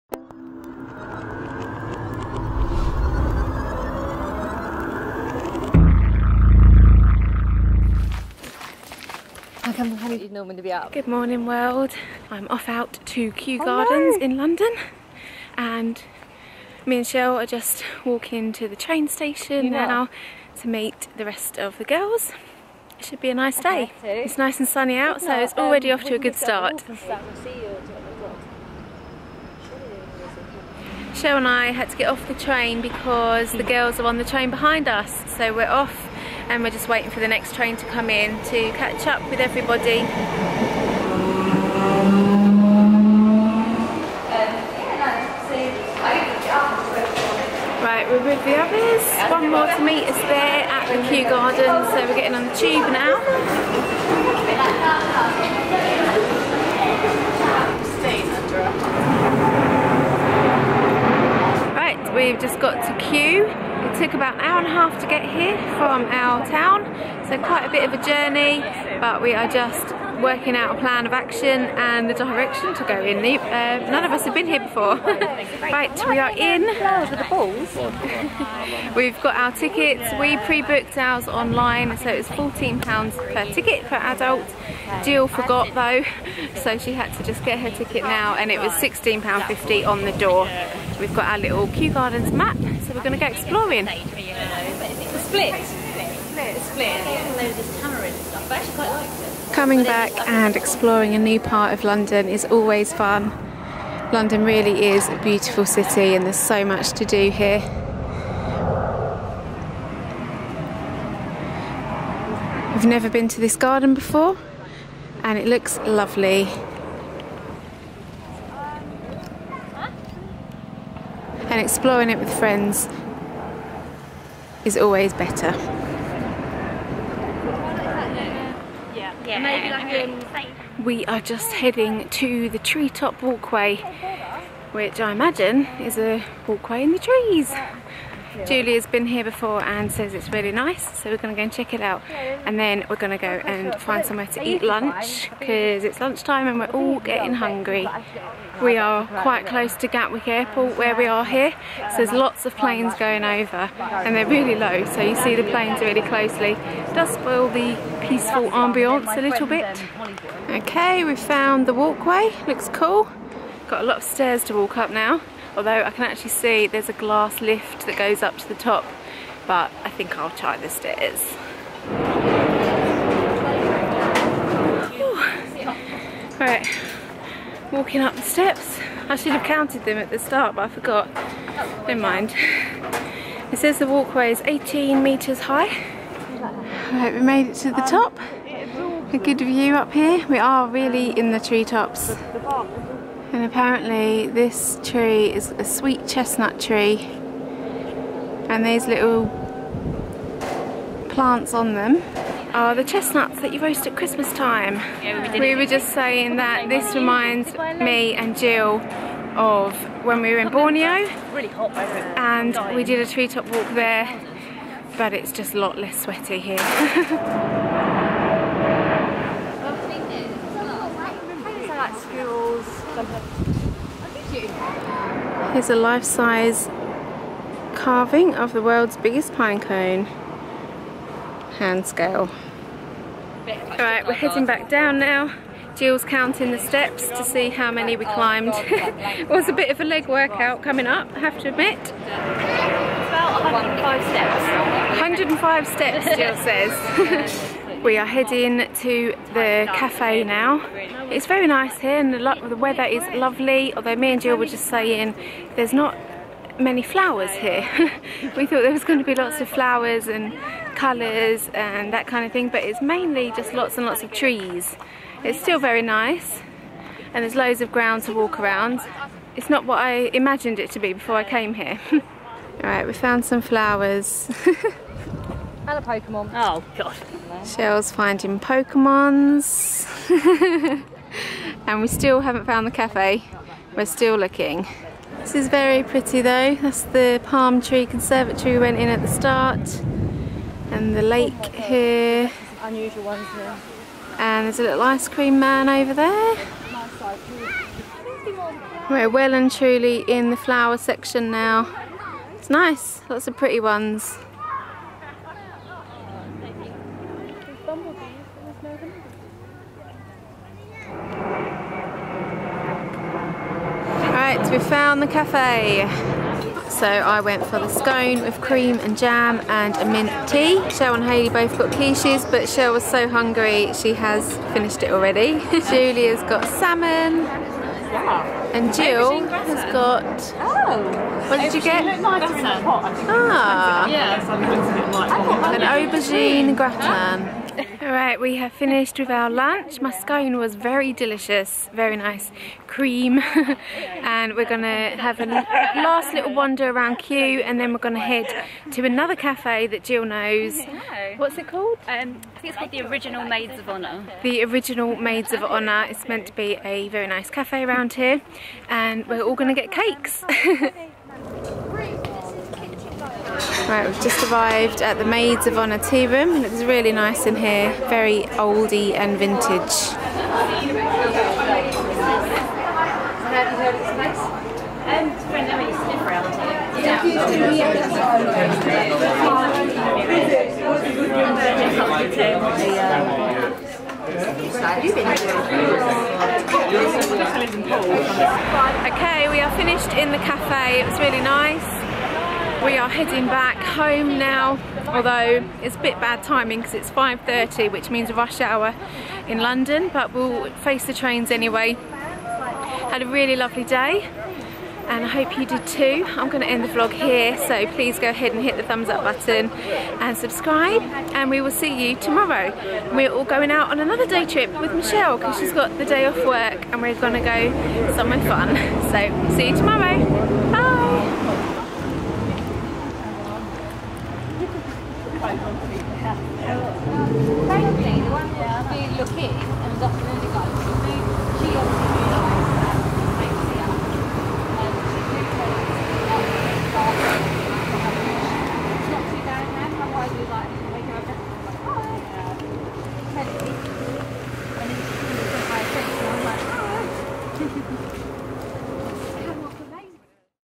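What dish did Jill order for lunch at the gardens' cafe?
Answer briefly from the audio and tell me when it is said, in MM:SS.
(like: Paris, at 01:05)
aubergine gratin, at 05:35.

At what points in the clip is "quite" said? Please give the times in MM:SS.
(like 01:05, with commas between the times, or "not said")
01:07, 02:29.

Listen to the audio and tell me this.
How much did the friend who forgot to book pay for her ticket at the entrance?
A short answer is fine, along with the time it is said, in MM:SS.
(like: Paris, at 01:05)
£16.50, at 01:28.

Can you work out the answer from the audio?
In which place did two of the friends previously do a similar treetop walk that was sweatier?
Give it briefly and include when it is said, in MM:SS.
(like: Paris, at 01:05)
Borneo, at 03:30.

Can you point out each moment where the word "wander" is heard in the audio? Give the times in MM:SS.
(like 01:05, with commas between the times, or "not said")
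05:46.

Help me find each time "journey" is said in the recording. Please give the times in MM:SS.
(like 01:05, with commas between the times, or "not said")
01:08.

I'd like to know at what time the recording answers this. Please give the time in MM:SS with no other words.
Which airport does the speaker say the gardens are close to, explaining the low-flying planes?
02:29.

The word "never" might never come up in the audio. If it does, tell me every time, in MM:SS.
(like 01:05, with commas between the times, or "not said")
01:52, 03:01.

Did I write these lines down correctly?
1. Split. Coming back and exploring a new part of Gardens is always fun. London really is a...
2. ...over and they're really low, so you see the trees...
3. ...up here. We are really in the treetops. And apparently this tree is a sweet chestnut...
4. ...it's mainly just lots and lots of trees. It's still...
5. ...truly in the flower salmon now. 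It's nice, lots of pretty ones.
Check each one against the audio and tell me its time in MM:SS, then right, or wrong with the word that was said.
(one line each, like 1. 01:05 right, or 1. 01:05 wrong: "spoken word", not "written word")
1. 01:35 wrong: "London", not "Gardens"
2. 02:33 wrong: "planes", not "trees"
3. 03:09 right
4. 04:22 right
5. 04:59 wrong: "section", not "salmon".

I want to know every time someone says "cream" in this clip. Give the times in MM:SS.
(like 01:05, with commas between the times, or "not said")
04:55, 05:18, 05:42.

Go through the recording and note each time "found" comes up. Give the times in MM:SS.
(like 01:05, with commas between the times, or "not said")
02:41, 04:32, 04:42, 05:14.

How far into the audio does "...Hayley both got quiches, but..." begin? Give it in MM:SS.
05:21.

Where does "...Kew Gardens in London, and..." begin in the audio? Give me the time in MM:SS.
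00:13.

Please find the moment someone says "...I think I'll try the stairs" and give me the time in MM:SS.
02:49.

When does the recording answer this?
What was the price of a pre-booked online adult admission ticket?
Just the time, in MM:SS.
01:22.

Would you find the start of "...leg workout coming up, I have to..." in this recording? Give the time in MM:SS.
03:59.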